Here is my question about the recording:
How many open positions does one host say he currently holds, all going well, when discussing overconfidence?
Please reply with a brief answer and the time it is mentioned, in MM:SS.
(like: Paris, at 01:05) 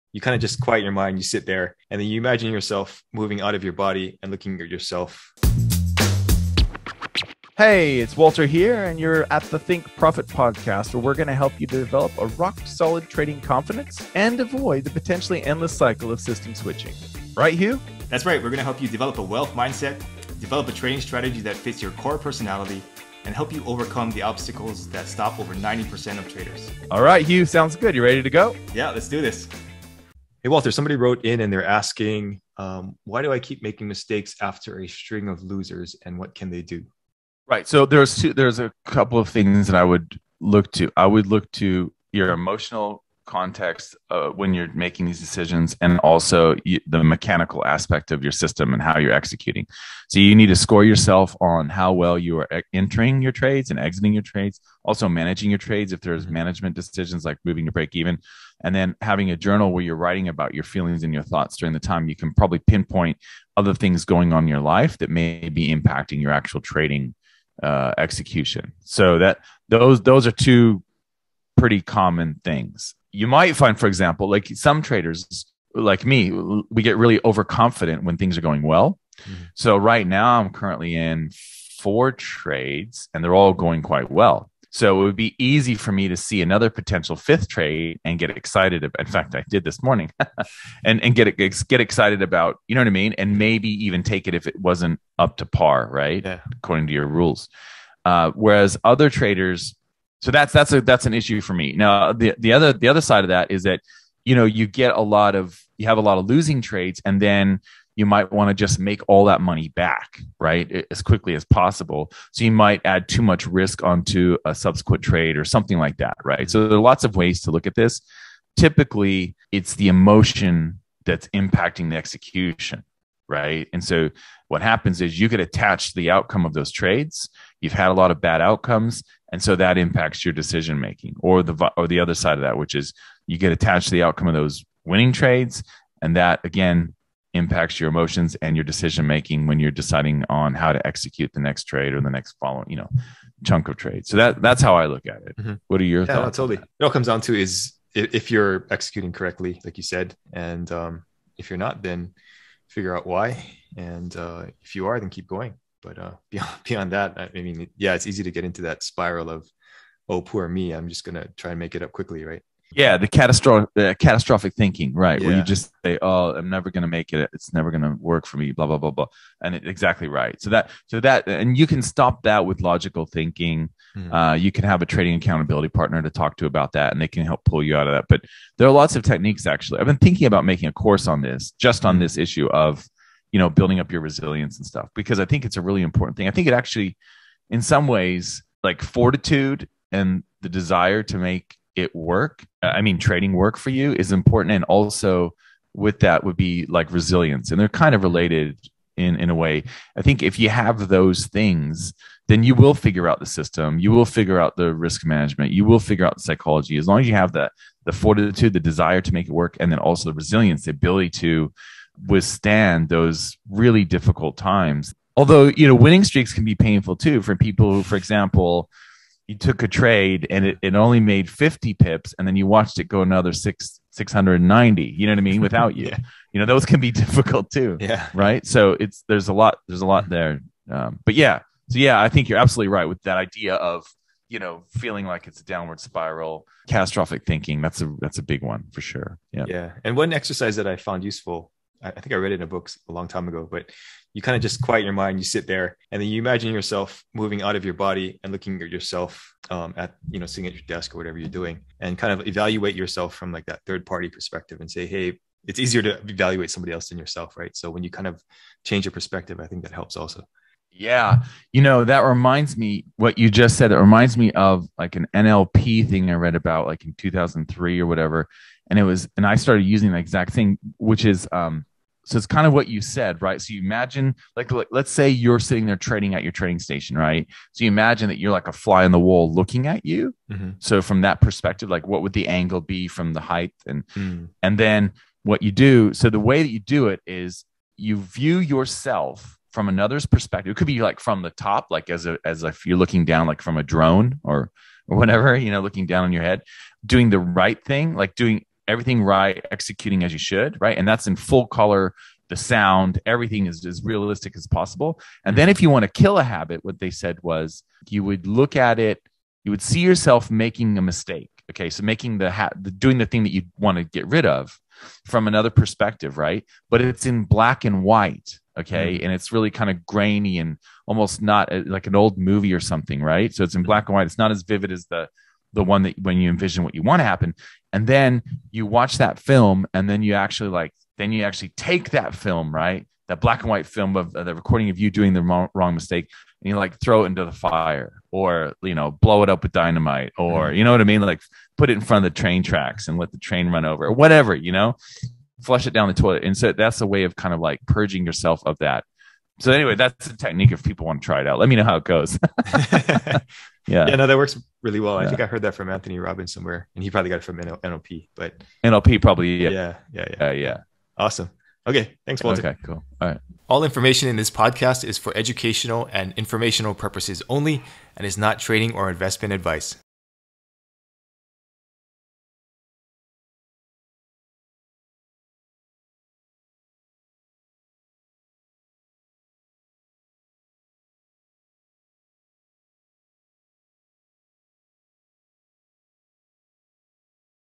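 4, at 01:21.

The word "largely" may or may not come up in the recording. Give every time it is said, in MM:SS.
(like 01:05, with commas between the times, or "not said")
not said.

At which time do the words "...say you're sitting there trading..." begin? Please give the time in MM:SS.
04:34.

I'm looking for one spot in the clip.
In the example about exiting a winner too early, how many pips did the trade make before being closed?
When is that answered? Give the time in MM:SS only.
03:41.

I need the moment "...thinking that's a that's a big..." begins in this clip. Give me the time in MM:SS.
03:57.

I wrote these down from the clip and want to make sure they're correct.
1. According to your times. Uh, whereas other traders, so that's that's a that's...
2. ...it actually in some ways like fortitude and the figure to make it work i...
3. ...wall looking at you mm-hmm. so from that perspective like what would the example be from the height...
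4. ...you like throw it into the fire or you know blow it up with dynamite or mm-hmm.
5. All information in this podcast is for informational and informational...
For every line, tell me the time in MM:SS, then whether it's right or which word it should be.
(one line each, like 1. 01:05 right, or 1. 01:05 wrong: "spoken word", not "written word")
1. 01:36 wrong: "rules", not "times"
2. 03:06 wrong: "desire", not "figure"
3. 04:38 wrong: "angle", not "example"
4. 05:36 right
5. 06:03 wrong: "educational", not "informational".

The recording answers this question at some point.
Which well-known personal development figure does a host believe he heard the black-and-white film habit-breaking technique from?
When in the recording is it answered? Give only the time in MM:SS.
05:55.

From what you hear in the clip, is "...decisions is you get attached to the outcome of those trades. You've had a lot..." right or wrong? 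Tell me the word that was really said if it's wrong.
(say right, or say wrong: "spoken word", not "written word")
wrong: "happens", not "decisions".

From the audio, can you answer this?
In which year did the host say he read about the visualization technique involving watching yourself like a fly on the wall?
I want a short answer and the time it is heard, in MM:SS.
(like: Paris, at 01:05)
2003, at 04:26.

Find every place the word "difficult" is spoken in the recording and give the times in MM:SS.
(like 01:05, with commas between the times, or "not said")
03:33, 03:46.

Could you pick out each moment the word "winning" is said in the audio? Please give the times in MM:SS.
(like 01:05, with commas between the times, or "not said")
02:14, 03:35.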